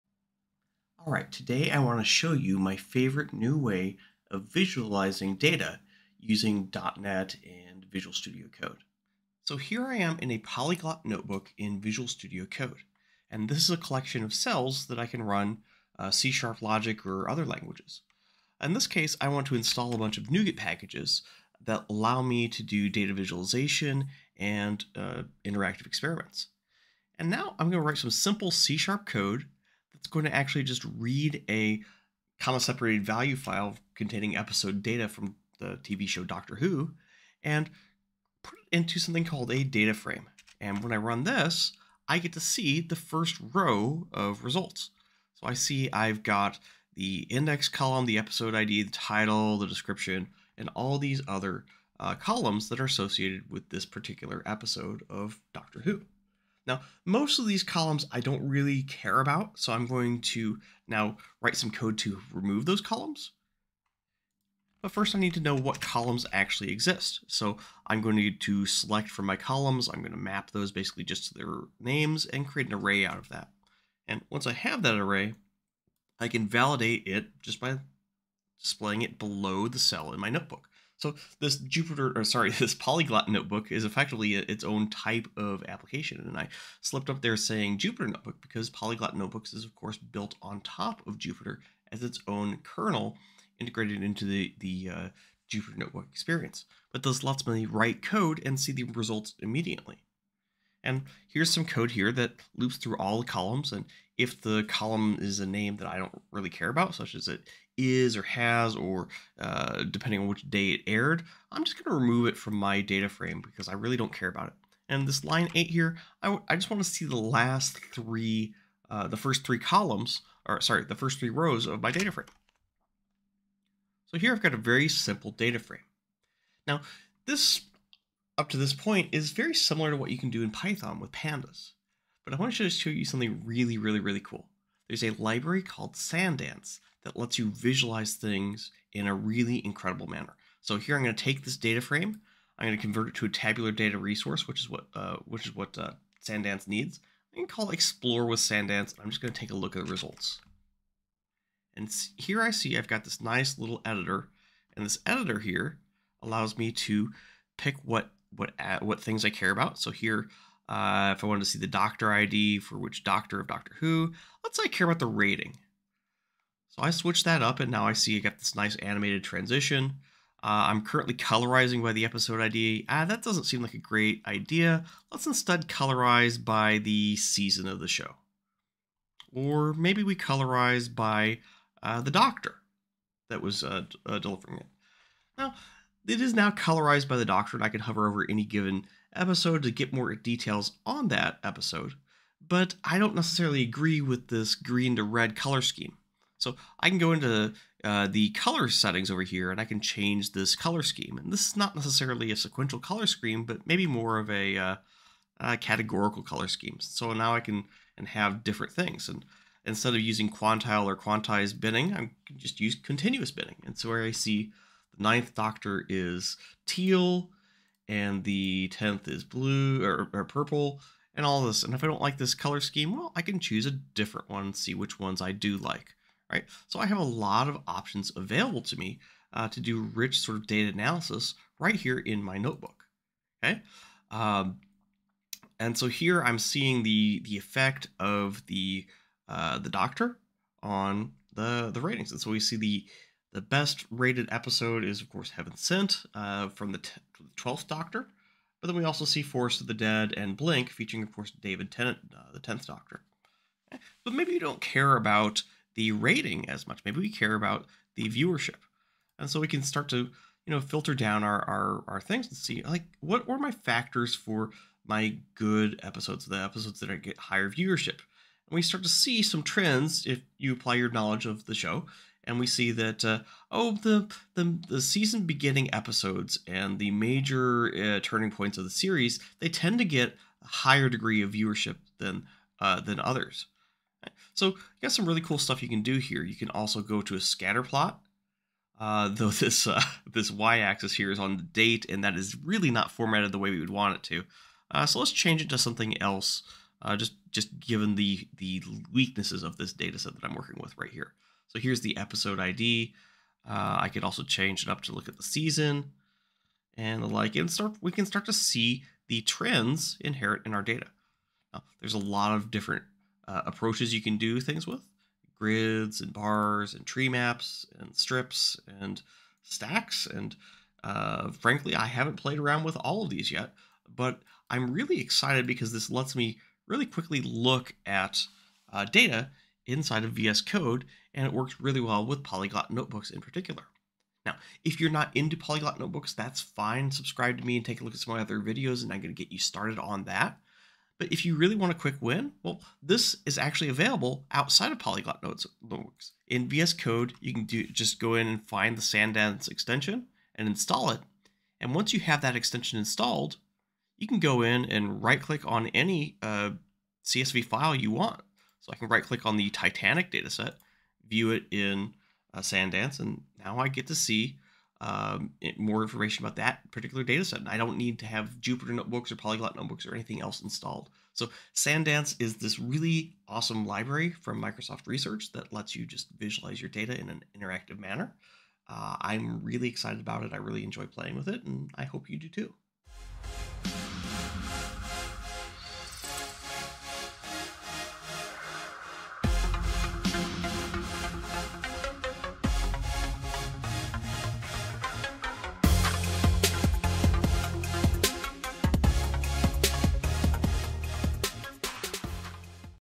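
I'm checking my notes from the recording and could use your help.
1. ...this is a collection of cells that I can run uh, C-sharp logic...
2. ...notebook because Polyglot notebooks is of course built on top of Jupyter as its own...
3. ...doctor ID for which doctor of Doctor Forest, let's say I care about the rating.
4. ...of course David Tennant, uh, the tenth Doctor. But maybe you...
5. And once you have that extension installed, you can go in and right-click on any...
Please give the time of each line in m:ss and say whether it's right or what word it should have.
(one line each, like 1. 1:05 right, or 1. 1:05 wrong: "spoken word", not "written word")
1. 0:13 right
2. 1:28 right
3. 2:41 wrong: "Who", not "Forest"
4. 4:11 right
5. 5:51 right.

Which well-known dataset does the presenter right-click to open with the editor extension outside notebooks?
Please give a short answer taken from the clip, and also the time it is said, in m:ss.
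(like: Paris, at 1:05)
Titanic, at 5:59.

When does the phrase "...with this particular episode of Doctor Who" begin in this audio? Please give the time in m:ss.
0:53.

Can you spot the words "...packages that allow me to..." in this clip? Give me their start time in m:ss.
0:20.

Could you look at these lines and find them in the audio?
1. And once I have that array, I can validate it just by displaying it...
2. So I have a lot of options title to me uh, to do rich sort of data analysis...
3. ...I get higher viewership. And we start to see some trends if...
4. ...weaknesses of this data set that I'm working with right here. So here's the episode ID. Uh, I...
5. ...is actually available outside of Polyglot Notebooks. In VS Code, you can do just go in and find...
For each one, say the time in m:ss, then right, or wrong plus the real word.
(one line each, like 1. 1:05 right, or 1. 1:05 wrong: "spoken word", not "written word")
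1. 1:14 right
2. 3:46 wrong: "available", not "title"
3. 4:26 right
4. 4:58 right
5. 5:43 right.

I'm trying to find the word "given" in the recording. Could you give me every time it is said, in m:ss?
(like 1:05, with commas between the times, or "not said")
3:08, 4:57.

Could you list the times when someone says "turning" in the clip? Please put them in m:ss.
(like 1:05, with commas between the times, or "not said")
4:38.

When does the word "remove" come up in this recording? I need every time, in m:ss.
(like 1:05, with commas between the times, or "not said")
1:02, 1:52.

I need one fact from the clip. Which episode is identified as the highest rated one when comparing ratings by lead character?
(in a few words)
Heaven Sent.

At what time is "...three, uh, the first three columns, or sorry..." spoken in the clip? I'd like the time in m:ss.
1:57.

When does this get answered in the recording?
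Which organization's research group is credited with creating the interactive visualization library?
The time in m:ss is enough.
6:14.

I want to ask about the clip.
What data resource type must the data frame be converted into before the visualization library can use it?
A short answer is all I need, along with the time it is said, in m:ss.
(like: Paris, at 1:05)
tabular data resource, at 2:23.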